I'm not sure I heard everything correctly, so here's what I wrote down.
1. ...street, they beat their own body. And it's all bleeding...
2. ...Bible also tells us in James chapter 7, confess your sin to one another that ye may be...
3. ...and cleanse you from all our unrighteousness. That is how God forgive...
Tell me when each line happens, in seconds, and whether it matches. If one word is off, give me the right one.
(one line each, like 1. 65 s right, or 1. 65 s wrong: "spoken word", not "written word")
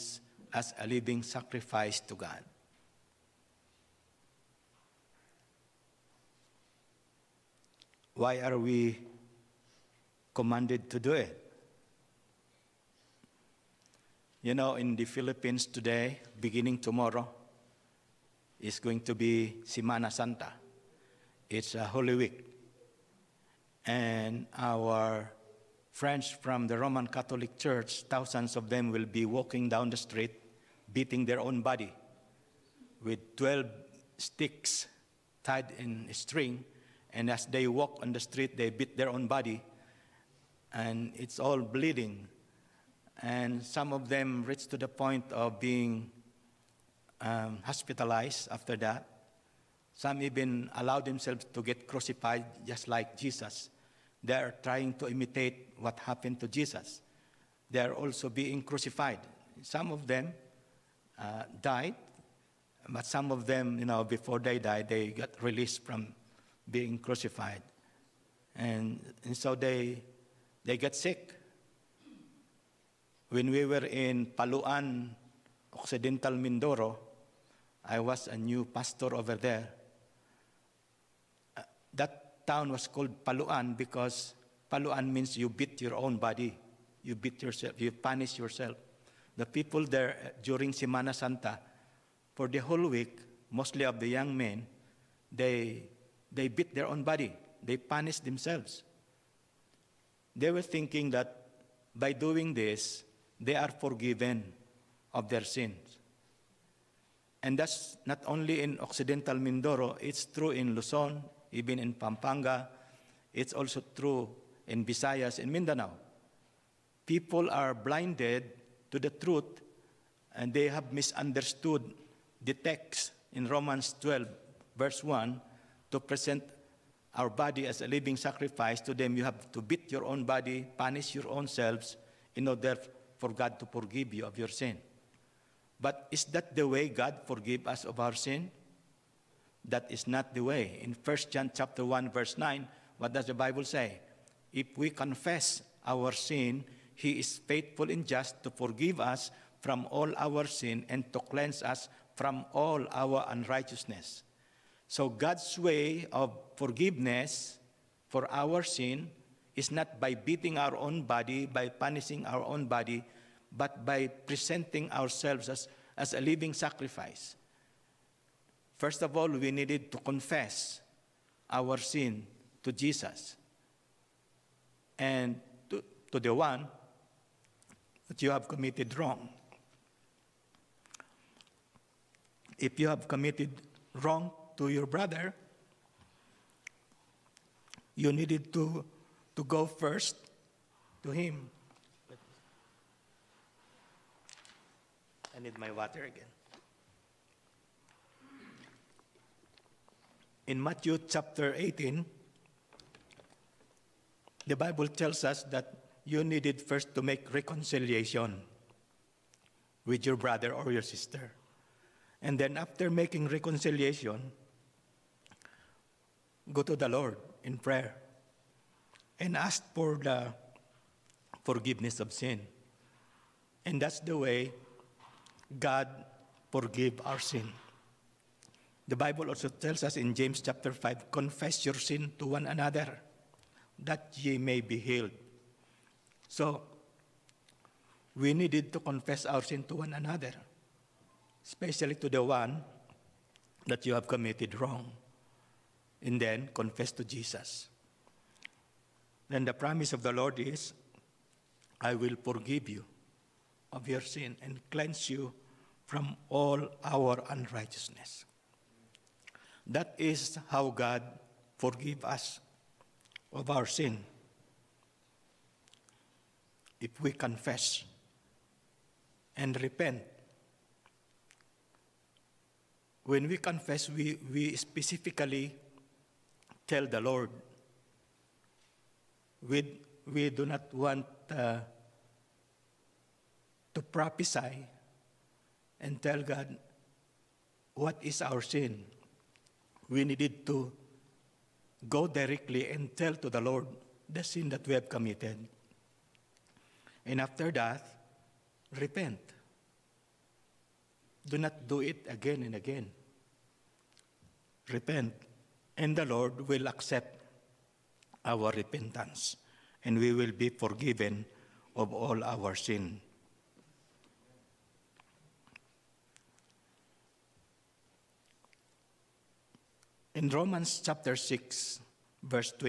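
1. 38 s right
2. 228 s wrong: "5", not "7"
3. 254 s right.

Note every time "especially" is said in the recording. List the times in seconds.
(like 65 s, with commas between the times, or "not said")
241 s.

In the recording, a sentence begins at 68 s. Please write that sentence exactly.
And, and so they, they got sick when we were in Paluan, Occidental Mindoro, I was a new pastor over there.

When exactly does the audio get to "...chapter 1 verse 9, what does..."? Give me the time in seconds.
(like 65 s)
141 s.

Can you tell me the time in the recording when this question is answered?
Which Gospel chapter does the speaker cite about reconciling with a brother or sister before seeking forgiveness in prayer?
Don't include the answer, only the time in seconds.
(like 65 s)
200 s.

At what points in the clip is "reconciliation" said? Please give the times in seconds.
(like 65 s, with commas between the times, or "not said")
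207 s, 213 s.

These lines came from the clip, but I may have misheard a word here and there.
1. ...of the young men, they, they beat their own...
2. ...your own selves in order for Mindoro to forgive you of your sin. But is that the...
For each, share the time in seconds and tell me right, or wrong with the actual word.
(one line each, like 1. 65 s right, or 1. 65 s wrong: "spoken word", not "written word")
1. 93 s right
2. 131 s wrong: "God", not "Mindoro".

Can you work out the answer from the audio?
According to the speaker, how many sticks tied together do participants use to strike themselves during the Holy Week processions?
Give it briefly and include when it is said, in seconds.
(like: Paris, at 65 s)
12, at 33 s.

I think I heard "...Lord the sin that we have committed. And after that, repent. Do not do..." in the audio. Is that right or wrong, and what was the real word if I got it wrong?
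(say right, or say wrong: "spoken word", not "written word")
right.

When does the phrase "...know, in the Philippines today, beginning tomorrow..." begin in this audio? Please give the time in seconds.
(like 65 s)
14 s.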